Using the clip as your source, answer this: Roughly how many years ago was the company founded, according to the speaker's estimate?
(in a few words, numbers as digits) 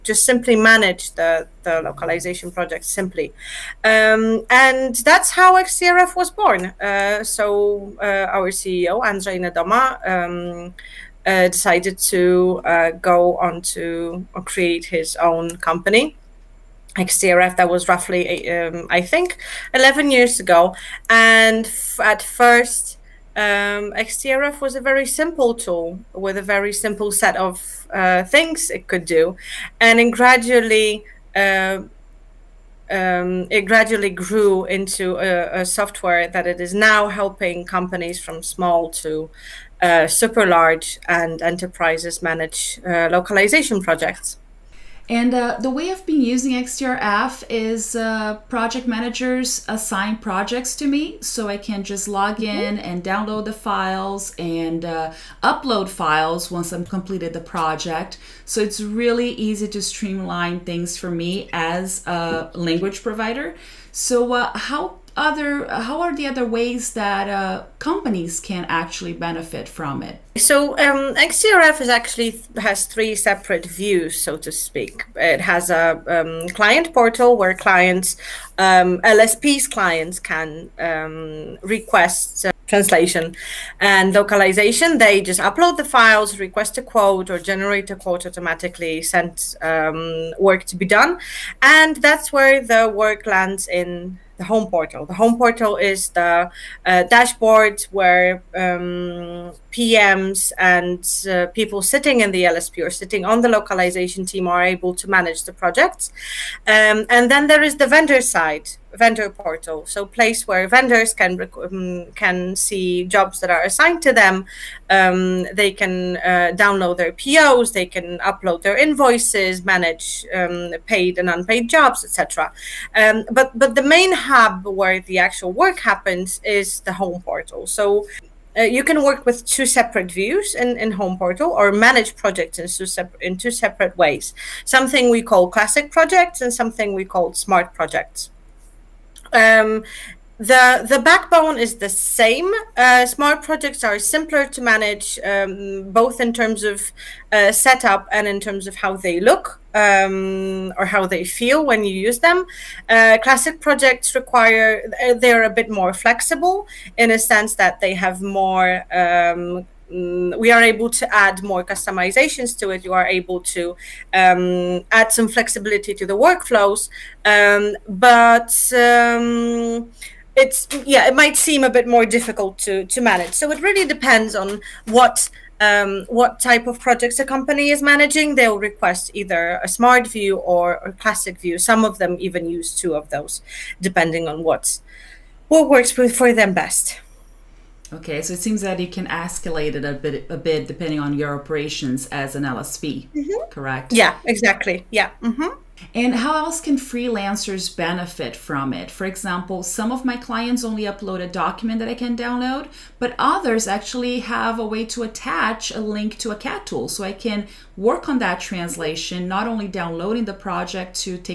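11.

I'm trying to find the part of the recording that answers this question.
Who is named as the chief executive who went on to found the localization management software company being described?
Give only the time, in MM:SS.
00:09.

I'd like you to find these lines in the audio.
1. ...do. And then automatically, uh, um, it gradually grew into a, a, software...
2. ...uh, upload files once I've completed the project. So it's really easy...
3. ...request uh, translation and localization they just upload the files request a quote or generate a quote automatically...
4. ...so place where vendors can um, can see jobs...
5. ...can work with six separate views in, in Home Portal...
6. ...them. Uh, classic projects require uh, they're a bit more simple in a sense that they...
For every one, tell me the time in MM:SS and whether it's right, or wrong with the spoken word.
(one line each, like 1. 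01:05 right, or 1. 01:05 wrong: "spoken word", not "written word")
1. 00:29 wrong: "gradually", not "automatically"
2. 00:54 right
3. 01:21 right
4. 01:49 right
5. 02:08 wrong: "two", not "six"
6. 02:32 wrong: "flexible", not "simple".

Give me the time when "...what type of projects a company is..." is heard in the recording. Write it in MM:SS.
02:56.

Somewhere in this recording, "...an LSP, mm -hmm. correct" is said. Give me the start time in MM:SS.
03:12.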